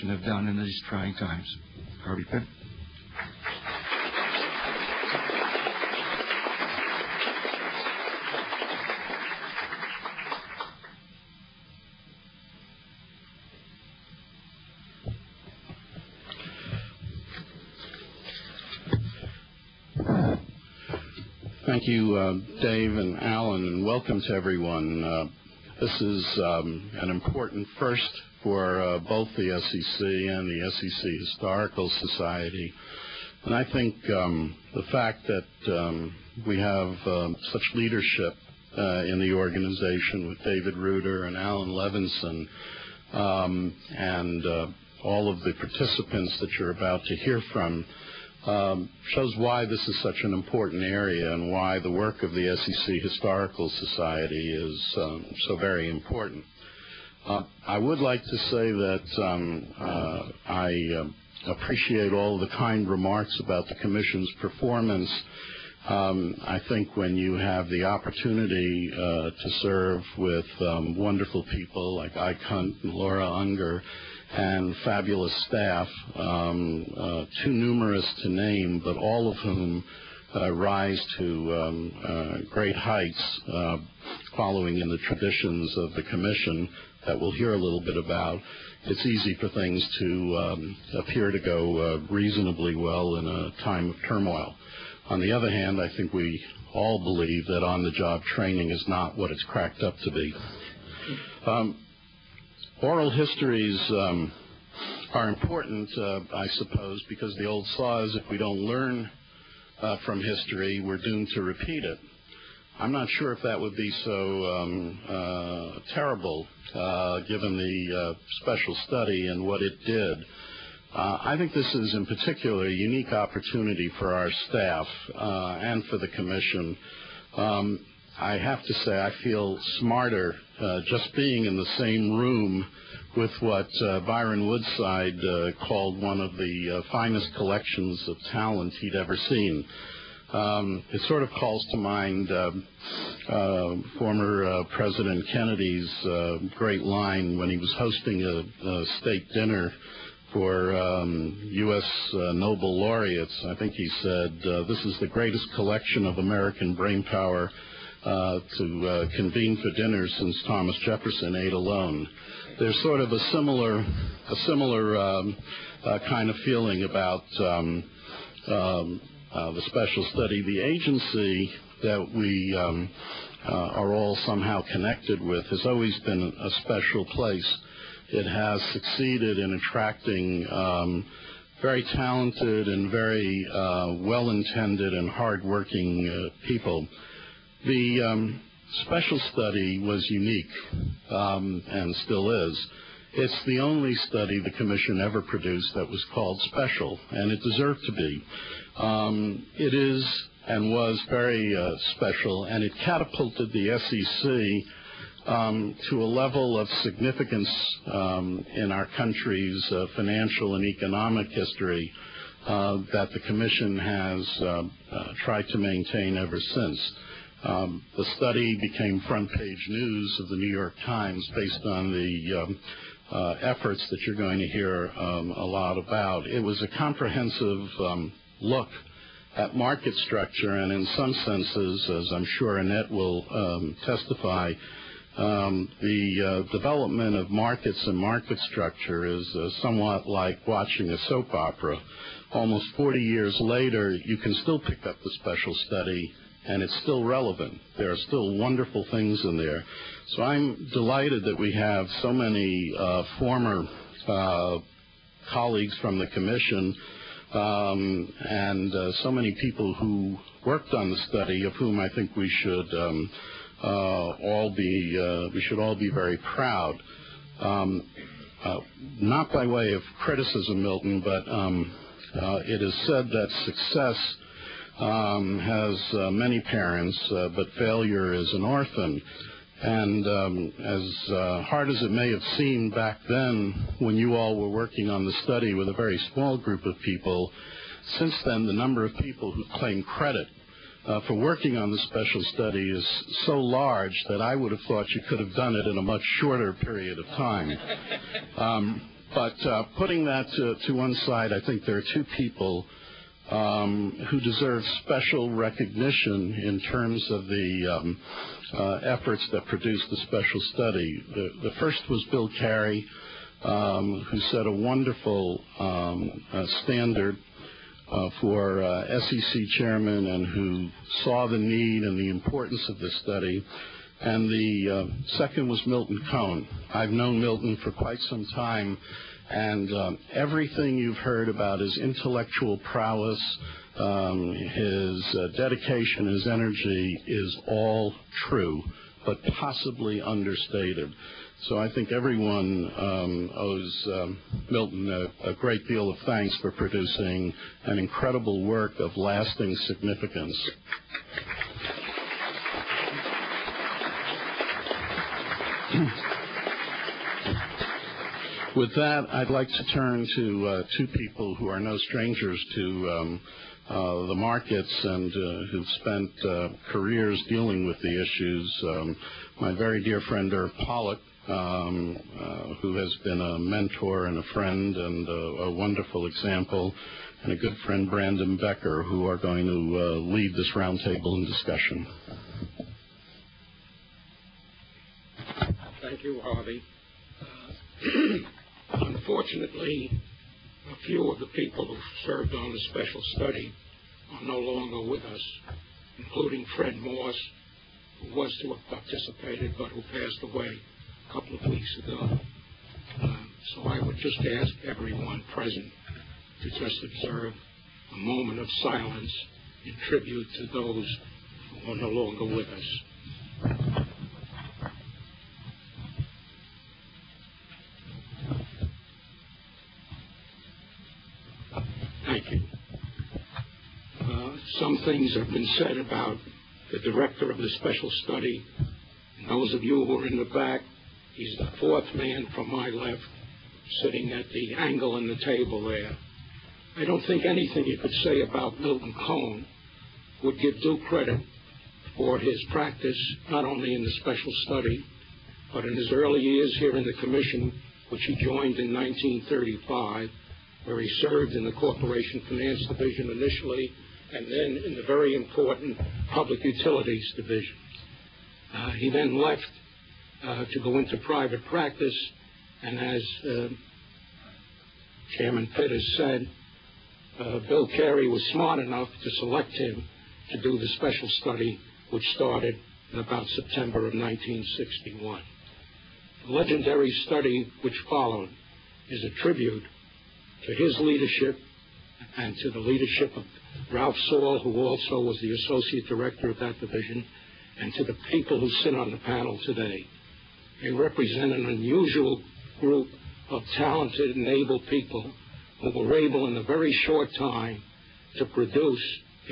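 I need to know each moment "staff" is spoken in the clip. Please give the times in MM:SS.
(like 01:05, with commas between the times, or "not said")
01:15, 02:04.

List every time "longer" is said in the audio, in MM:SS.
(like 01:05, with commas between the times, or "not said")
06:34, 06:51.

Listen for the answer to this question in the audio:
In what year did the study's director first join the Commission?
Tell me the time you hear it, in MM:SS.
07:28.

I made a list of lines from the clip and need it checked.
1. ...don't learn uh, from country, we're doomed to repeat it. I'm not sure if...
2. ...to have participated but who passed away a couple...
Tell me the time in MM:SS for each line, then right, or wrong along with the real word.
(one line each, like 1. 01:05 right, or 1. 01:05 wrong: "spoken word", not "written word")
1. 01:48 wrong: "history", not "country"
2. 06:38 right.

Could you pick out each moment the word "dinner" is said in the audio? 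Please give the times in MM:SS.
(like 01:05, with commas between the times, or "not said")
02:29, 02:39.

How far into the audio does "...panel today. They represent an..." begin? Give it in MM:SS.
08:08.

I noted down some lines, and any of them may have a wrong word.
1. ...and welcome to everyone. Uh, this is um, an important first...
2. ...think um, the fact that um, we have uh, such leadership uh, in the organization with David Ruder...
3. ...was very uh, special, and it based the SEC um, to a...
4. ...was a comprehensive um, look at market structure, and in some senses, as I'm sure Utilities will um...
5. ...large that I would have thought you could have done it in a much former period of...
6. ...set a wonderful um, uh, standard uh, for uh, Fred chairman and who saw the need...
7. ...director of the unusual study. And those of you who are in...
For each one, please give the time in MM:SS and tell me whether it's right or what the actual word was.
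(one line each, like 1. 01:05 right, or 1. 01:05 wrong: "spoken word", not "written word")
1. 00:23 right
2. 00:33 right
3. 03:20 wrong: "catapulted", not "based"
4. 03:46 wrong: "Annette", not "Utilities"
5. 04:53 wrong: "shorter", not "former"
6. 05:14 wrong: "SEC", not "Fred"
7. 07:06 wrong: "special", not "unusual".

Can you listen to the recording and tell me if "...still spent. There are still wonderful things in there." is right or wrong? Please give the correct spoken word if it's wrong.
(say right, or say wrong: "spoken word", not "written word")
wrong: "relevant", not "spent".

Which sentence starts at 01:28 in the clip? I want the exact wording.
It's easy for things to um, appear to go uh, reasonably well in a time of turmoil.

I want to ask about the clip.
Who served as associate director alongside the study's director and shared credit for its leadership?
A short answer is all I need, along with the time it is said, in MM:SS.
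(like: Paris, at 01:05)
Ralph Saul, at 08:03.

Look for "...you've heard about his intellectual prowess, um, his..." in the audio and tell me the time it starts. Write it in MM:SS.
05:30.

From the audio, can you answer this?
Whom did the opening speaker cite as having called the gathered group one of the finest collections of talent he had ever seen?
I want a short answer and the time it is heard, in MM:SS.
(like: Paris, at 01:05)
Byron Woodside, at 02:13.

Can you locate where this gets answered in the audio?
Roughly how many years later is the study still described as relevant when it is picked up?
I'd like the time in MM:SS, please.
04:02.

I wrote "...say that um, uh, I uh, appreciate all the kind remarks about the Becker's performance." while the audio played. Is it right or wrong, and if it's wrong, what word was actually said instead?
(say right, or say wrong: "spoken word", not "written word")
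wrong: "Commission", not "Becker".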